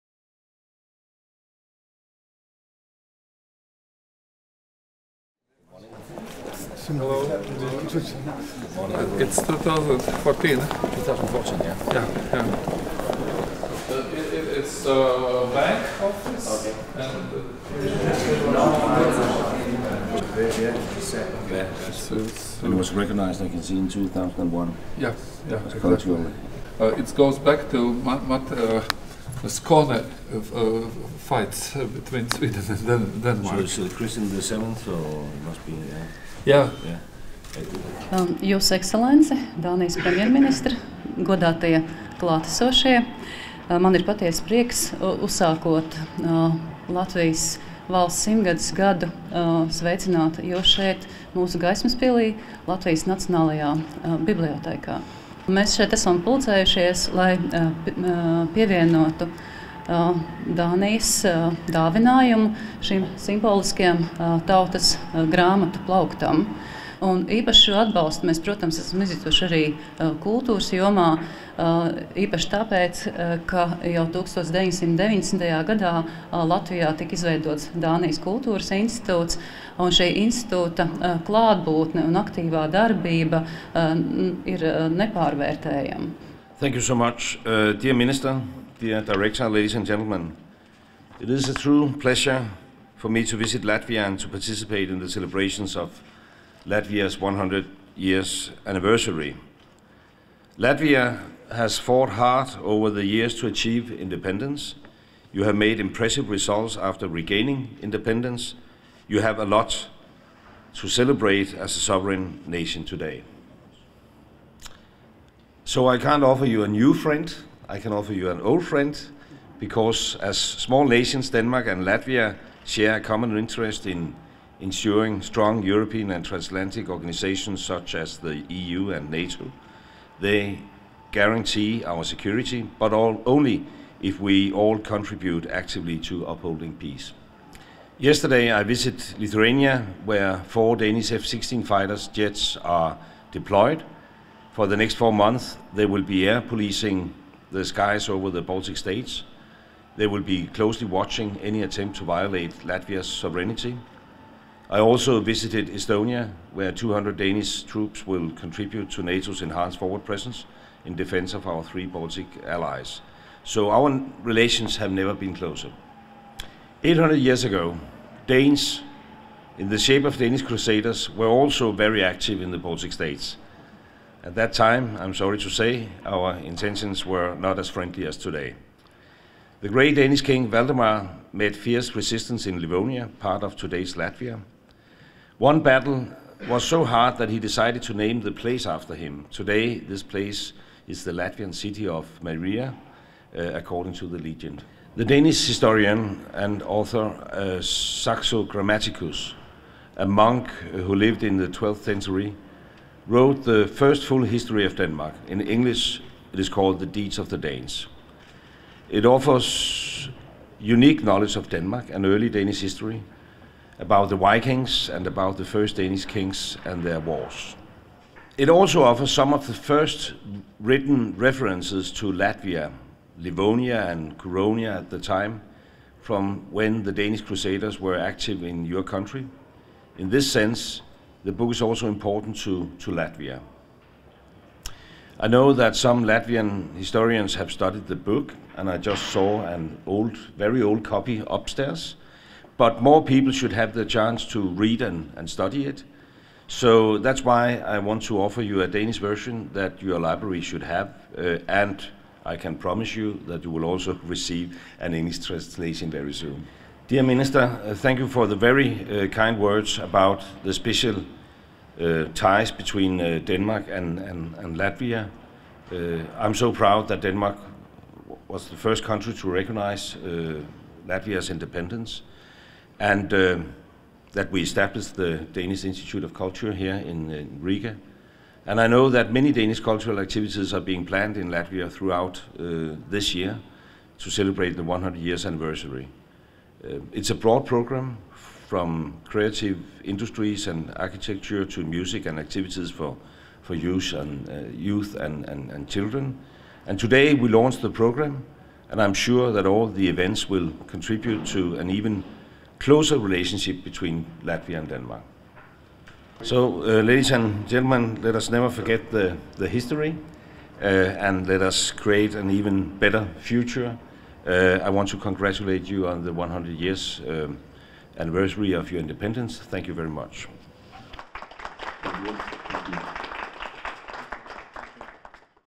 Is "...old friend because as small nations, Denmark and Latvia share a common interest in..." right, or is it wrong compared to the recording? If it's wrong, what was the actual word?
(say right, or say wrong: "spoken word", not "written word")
right.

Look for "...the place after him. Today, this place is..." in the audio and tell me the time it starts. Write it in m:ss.
3:08.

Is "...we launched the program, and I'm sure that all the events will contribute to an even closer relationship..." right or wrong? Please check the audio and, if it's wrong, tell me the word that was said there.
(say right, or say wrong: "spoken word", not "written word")
right.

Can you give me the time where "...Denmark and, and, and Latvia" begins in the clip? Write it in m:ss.
4:23.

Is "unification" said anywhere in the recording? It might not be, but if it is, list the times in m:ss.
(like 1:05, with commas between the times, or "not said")
not said.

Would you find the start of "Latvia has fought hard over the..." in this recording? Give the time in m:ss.
1:40.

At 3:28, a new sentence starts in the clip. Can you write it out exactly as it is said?
It offers unique knowledge of Denmark and early Danish history, about the Vikings and about the first Danish kings and their wars.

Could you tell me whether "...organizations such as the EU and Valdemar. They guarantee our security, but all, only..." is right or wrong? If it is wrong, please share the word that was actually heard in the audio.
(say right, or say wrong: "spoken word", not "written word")
wrong: "NATO", not "Valdemar".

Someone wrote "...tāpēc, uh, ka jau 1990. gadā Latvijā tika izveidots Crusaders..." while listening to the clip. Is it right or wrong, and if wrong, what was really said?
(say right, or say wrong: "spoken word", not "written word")
wrong: "Dānijas", not "Crusaders".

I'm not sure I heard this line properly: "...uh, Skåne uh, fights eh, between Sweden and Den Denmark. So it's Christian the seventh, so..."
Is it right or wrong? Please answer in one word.
right.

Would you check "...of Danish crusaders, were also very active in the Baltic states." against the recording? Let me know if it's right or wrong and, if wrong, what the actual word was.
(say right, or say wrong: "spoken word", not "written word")
right.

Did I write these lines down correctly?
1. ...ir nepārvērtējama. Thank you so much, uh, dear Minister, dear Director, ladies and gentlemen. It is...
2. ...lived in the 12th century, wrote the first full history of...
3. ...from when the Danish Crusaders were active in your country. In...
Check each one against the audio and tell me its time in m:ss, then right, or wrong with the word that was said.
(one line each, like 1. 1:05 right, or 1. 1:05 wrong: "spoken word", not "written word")
1. 1:24 right
2. 3:20 right
3. 3:46 right.